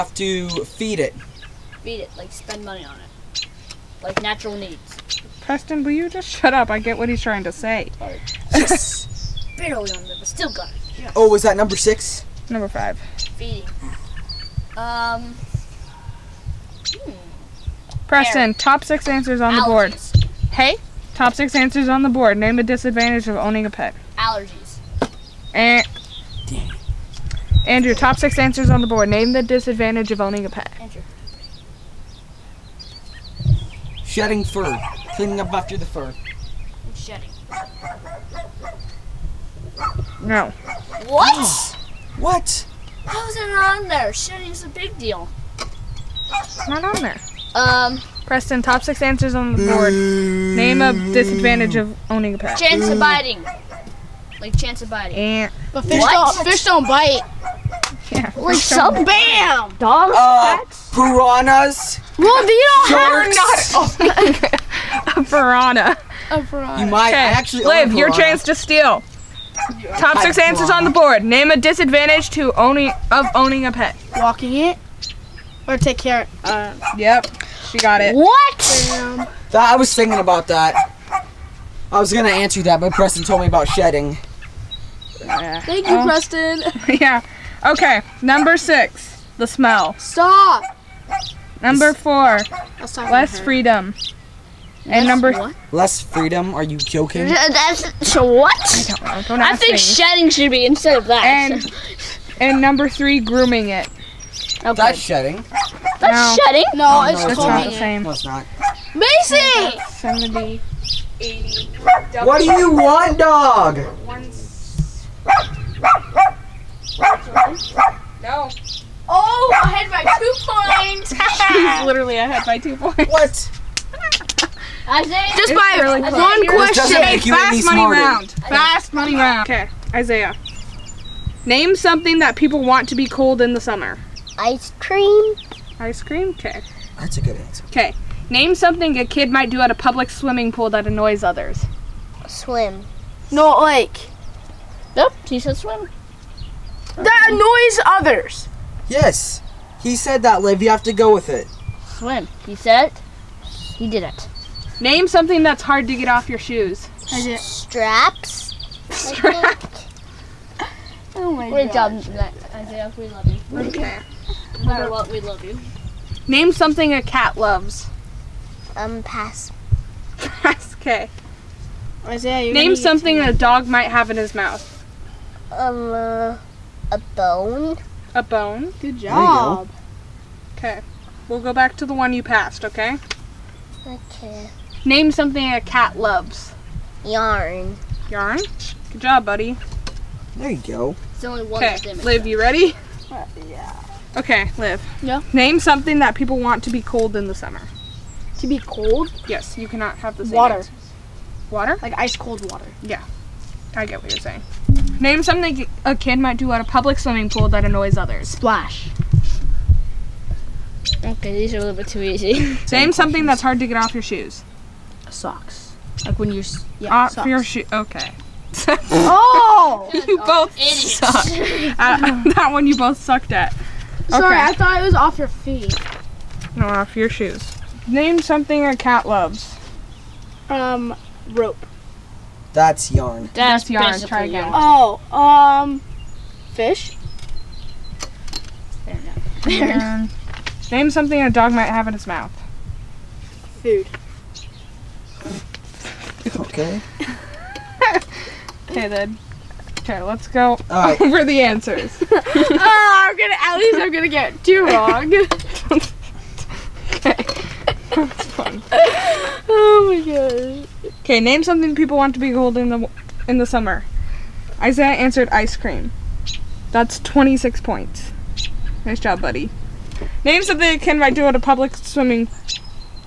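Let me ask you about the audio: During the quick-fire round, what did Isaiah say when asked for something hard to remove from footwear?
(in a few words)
Straps.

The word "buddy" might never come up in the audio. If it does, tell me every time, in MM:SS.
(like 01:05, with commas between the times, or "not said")
03:09, 04:29.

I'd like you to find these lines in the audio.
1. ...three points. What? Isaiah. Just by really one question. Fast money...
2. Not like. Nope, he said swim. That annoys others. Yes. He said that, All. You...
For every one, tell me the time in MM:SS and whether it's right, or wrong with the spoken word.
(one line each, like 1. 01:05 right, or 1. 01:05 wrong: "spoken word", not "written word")
1. 02:02 wrong: "two", not "three"
2. 02:23 wrong: "Liv", not "All".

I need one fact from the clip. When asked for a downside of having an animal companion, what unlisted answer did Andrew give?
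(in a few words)
Shedding fur.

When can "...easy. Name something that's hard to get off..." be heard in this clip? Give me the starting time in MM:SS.
03:32.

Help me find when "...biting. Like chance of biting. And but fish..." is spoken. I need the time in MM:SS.
00:52.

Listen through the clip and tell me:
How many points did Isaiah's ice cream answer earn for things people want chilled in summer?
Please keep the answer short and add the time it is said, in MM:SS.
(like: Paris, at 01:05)
26, at 04:27.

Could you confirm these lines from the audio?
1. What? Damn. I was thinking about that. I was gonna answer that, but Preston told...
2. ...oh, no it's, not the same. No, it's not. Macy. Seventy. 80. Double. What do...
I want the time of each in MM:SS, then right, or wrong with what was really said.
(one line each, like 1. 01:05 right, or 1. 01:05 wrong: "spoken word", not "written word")
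1. 01:18 right
2. 01:47 right.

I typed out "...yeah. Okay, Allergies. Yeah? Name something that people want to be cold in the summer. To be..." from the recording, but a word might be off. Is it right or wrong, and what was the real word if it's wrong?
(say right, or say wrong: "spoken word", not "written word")
wrong: "Liv", not "Allergies".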